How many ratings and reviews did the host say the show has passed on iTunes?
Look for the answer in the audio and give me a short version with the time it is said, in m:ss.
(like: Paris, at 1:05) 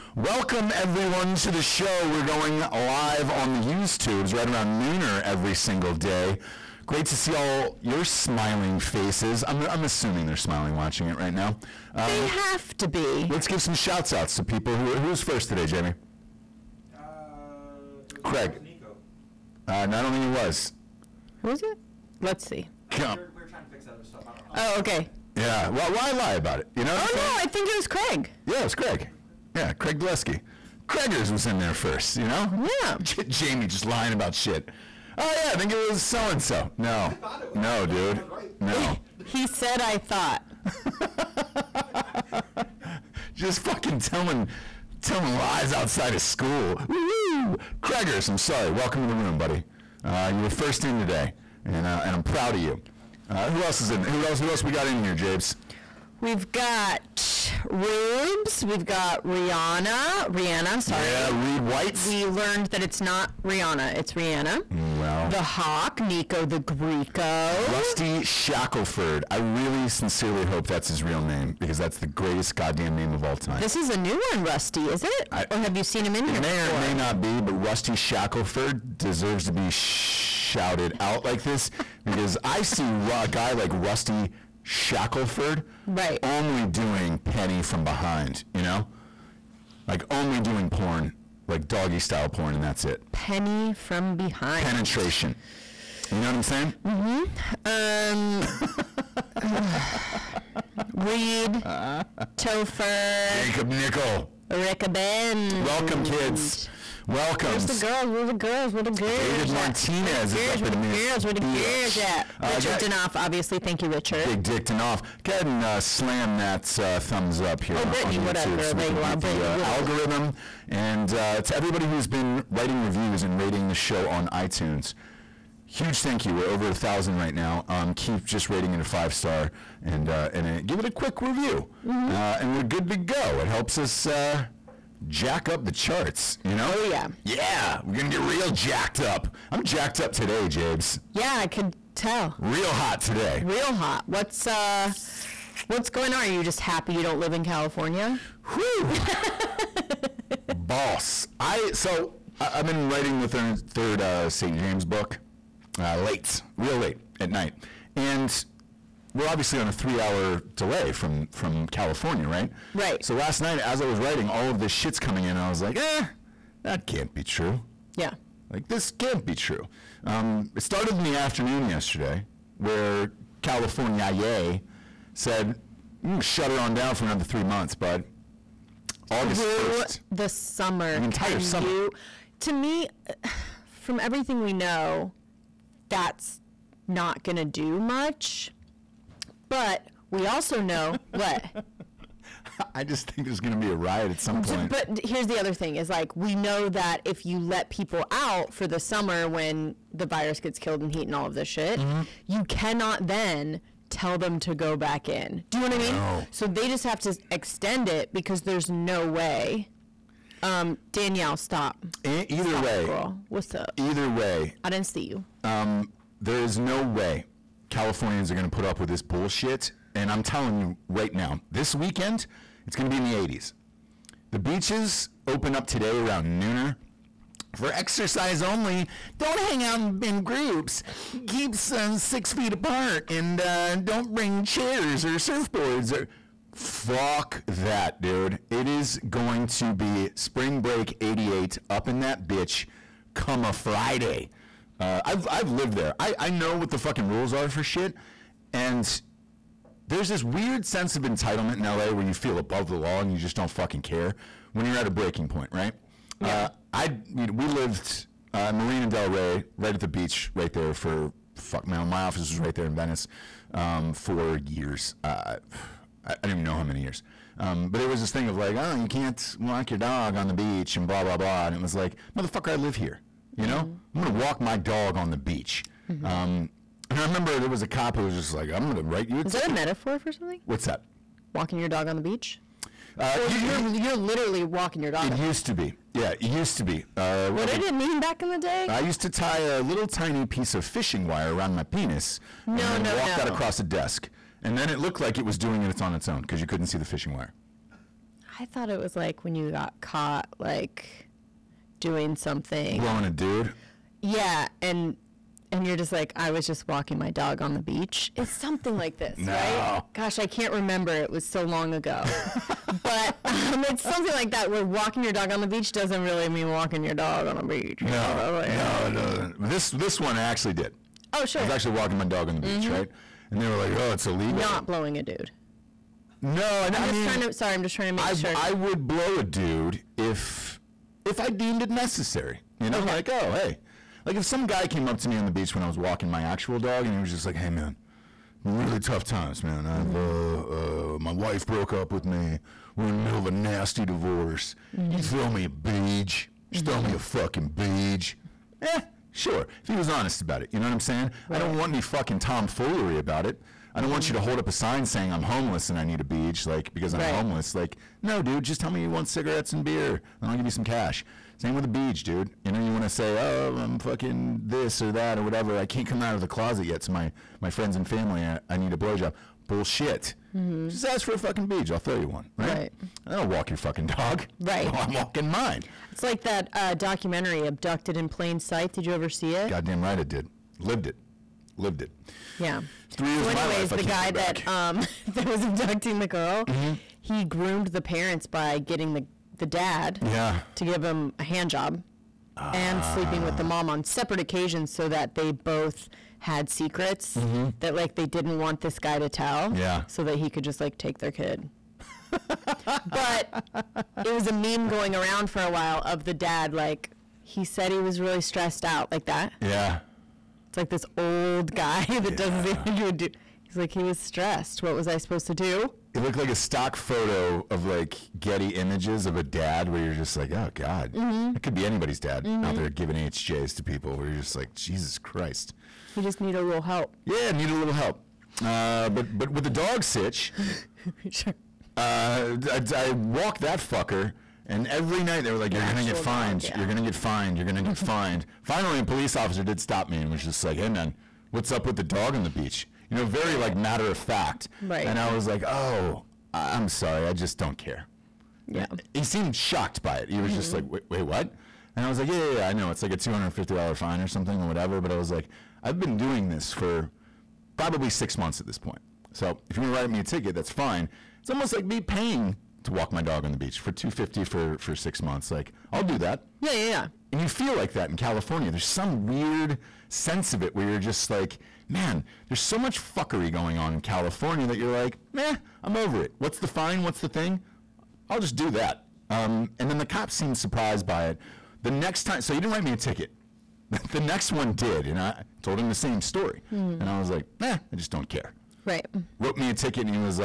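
Over a thousand, at 2:06.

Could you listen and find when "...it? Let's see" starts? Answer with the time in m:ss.
0:21.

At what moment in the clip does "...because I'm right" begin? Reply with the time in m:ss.
5:56.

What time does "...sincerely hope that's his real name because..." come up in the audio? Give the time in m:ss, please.
1:09.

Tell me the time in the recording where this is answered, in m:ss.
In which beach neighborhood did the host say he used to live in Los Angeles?
4:18.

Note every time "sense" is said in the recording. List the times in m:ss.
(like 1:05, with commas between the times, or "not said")
4:10, 7:49.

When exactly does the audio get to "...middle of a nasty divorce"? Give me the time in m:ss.
5:43.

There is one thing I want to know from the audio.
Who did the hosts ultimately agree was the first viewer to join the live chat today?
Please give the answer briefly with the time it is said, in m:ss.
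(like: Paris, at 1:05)
Craig Gillespie, at 0:29.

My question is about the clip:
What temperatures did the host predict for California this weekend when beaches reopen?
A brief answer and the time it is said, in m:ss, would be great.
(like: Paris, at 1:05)
The 80s, at 3:43.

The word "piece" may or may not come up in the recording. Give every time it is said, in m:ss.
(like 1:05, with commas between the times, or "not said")
4:50.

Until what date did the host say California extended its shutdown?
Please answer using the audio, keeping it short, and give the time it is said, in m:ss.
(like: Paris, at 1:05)
August 1, at 2:59.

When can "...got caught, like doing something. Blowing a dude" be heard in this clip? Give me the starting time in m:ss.
4:59.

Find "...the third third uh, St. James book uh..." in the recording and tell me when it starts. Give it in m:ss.
2:33.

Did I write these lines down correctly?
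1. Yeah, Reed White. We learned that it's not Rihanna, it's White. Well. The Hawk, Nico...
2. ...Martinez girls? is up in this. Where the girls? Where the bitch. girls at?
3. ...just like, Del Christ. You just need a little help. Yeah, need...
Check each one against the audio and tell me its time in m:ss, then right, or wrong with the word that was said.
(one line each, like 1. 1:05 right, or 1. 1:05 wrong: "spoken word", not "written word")
1. 1:01 wrong: "Rihanna", not "White"
2. 1:49 right
3. 7:04 wrong: "Jesus", not "Del".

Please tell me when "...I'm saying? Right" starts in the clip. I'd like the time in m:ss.
5:50.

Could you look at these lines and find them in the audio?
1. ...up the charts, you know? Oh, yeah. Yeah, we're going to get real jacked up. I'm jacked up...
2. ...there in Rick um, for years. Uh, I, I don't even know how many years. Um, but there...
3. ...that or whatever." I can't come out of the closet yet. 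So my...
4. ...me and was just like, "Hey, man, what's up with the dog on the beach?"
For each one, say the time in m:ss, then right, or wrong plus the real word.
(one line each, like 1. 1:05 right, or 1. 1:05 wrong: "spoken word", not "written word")
1. 2:15 right
2. 4:22 wrong: "Venice", not "Rick"
3. 6:04 right
4. 7:19 right.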